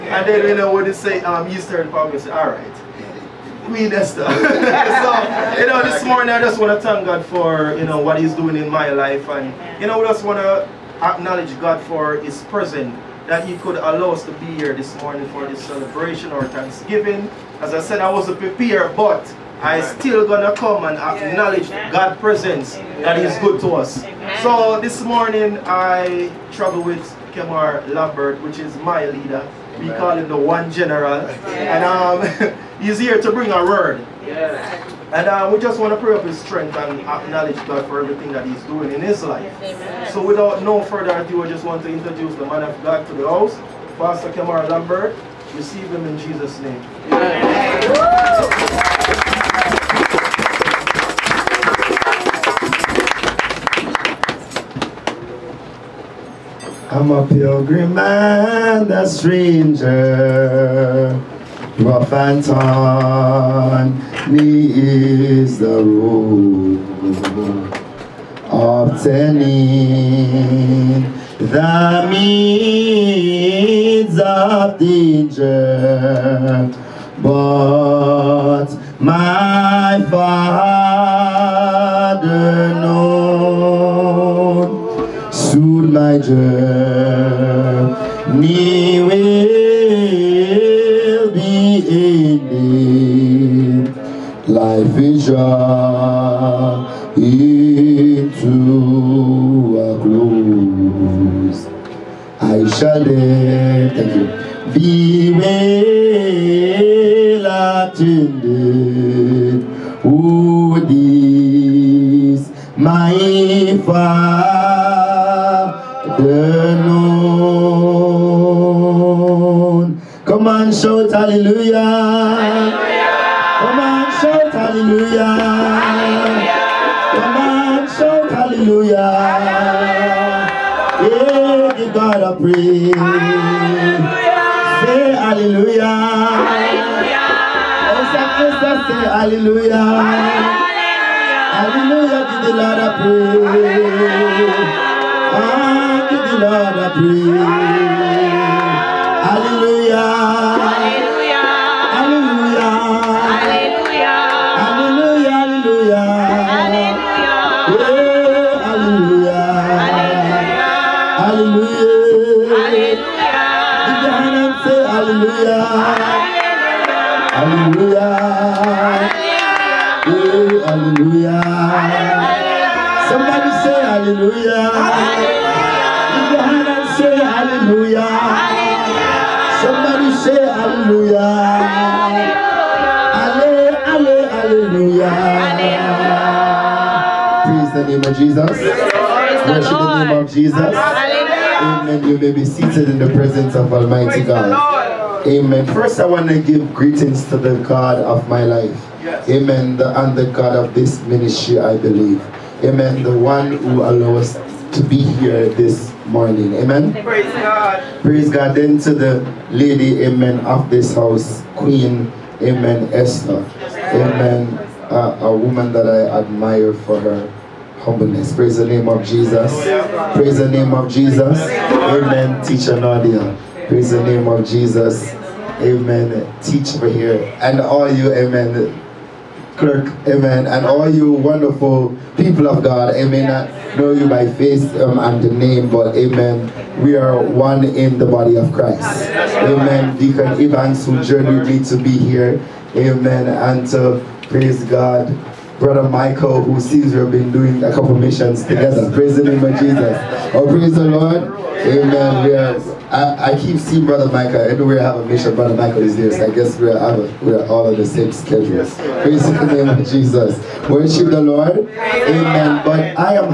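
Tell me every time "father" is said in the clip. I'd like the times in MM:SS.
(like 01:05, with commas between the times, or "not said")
01:20, 01:53.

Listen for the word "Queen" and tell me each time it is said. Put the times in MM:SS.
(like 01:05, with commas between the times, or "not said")
00:03, 03:31.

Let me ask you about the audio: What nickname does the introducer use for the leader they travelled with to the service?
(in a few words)
The one general.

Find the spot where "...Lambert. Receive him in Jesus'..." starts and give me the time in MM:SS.
00:44.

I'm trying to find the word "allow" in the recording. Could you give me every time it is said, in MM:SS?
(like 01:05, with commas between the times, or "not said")
00:13, 03:23.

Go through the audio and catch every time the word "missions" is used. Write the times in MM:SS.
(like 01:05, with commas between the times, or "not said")
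04:07, 04:15.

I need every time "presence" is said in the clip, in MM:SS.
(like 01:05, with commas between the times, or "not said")
00:12, 00:22, 03:13.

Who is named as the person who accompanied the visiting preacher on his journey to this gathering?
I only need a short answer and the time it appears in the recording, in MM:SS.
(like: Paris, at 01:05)
Deacon Evans, at 03:59.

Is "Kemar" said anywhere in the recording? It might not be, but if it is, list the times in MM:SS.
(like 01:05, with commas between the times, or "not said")
00:27.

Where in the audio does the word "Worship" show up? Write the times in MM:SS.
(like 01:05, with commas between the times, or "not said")
03:08, 04:20.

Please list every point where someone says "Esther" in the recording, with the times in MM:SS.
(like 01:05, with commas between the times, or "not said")
00:03, 03:32.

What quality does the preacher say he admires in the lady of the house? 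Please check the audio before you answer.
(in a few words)
Her humbleness.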